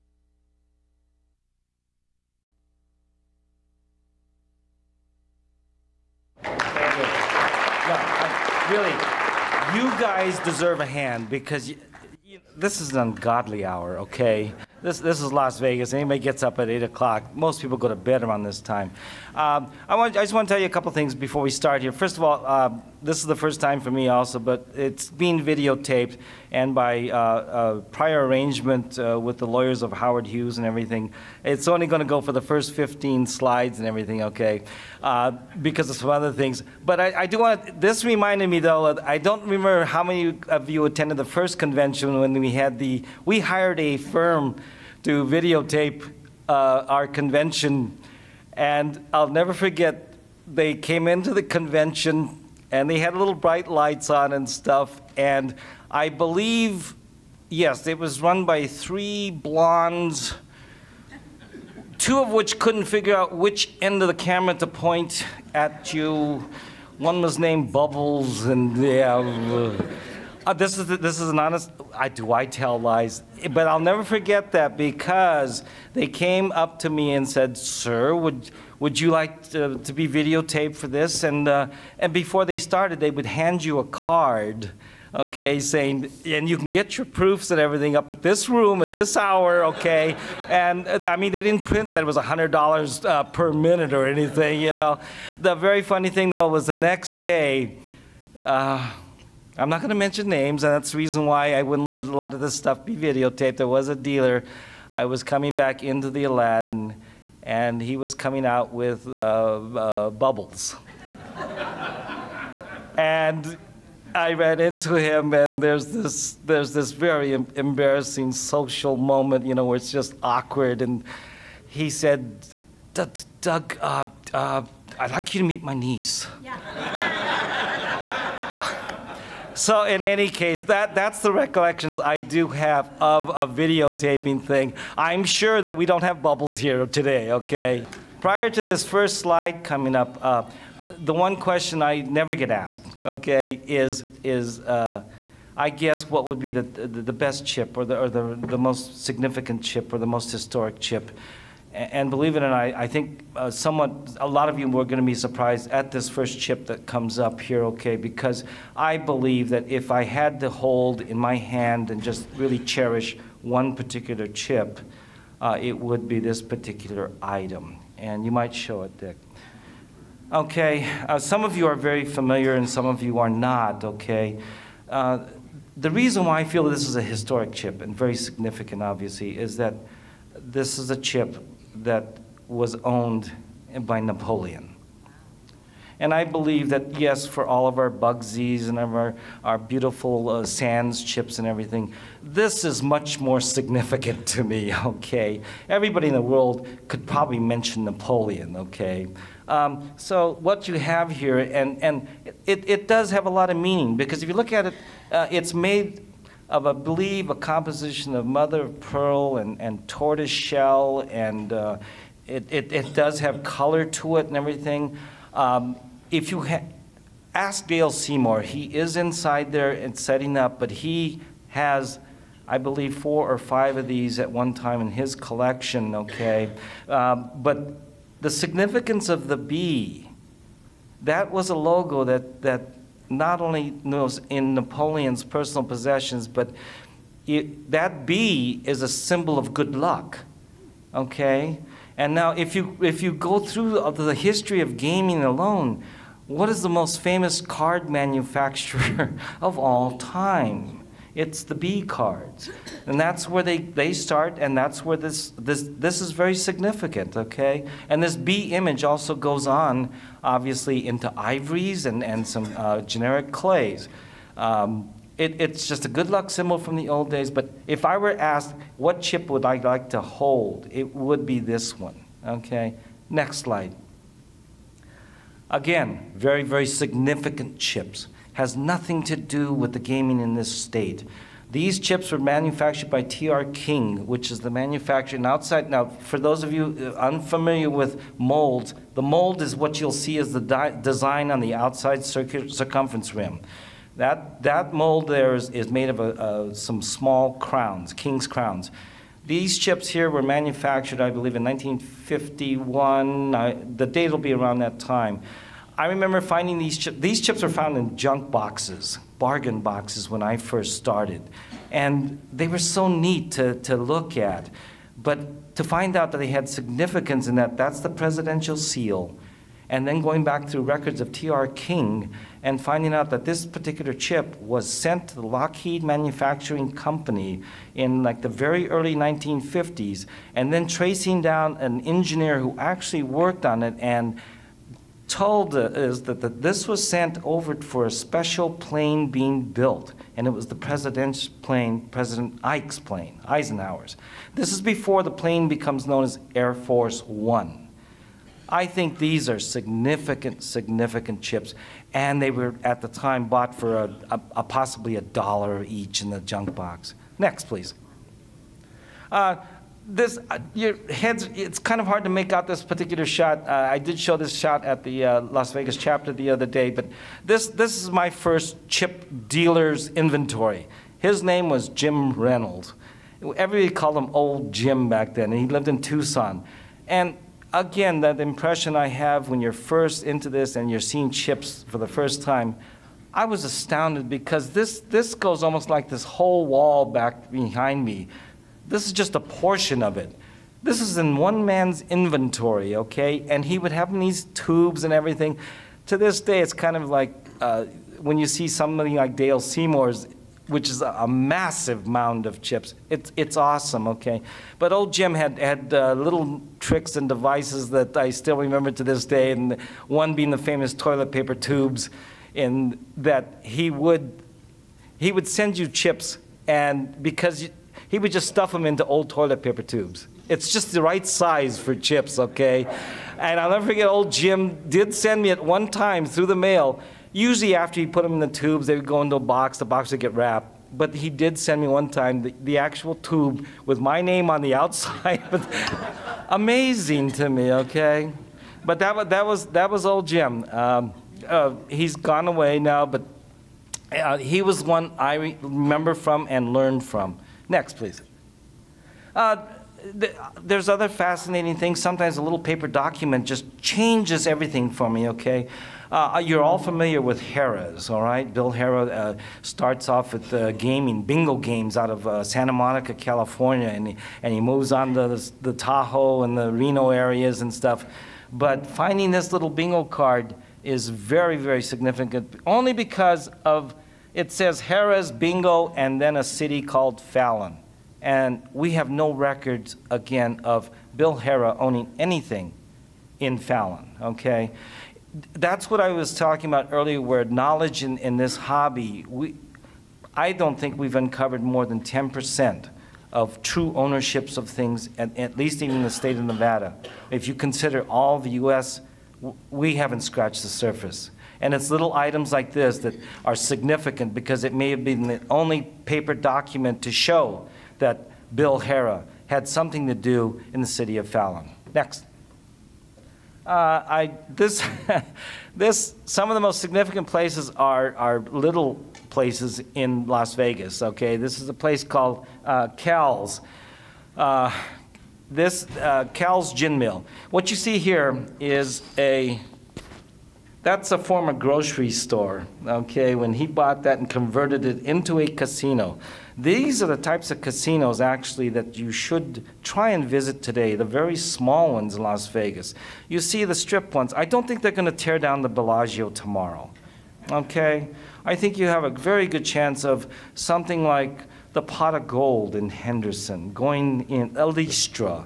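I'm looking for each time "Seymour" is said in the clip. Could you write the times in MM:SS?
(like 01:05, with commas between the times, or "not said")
03:37, 06:39.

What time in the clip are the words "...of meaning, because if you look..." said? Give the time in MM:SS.
03:23.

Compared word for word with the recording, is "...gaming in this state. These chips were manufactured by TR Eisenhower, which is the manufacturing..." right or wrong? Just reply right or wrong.
wrong.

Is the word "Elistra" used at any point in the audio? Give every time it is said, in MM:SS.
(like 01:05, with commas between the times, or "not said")
09:14.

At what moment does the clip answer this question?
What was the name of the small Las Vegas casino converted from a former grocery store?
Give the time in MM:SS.
08:46.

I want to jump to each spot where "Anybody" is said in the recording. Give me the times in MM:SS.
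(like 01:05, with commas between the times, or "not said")
00:15.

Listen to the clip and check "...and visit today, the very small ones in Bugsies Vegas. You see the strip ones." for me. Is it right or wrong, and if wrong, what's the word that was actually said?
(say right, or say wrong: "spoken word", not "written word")
wrong: "Las", not "Bugsies".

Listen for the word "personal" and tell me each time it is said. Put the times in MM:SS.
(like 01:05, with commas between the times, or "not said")
03:55.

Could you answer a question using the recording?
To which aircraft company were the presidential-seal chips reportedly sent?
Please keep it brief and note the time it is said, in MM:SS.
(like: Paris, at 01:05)
Lockheed, at 05:25.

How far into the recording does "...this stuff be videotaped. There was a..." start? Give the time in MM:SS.
01:42.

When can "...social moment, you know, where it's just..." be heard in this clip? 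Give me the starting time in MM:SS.
01:58.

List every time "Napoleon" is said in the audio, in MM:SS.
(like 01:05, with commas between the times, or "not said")
03:04, 03:17, 03:54.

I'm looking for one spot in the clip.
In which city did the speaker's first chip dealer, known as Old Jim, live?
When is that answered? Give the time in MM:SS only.
06:15.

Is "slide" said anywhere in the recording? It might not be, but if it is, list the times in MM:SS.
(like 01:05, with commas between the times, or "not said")
00:33, 02:19, 04:33.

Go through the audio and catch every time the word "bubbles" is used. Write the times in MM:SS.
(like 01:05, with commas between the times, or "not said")
01:07, 01:50, 02:16.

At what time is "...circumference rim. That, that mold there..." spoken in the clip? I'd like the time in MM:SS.
04:52.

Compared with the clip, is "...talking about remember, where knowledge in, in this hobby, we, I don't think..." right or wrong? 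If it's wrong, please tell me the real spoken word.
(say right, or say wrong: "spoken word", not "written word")
wrong: "earlier", not "remember".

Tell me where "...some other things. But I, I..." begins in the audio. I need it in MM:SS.
00:35.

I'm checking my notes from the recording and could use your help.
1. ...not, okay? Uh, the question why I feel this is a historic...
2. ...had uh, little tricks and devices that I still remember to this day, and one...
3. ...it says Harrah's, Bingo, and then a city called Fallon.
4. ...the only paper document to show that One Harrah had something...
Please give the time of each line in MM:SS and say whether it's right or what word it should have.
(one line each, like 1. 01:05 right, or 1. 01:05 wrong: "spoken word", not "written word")
1. 02:53 wrong: "reason", not "question"
2. 06:45 right
3. 07:54 right
4. 08:25 wrong: "Bill", not "One".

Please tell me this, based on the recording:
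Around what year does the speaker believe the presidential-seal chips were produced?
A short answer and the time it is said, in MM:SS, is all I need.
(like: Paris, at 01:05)
1951, at 05:01.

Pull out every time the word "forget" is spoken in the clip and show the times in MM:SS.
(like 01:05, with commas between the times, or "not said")
00:49, 01:14, 07:03.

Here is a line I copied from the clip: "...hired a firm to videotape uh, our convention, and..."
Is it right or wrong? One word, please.
right.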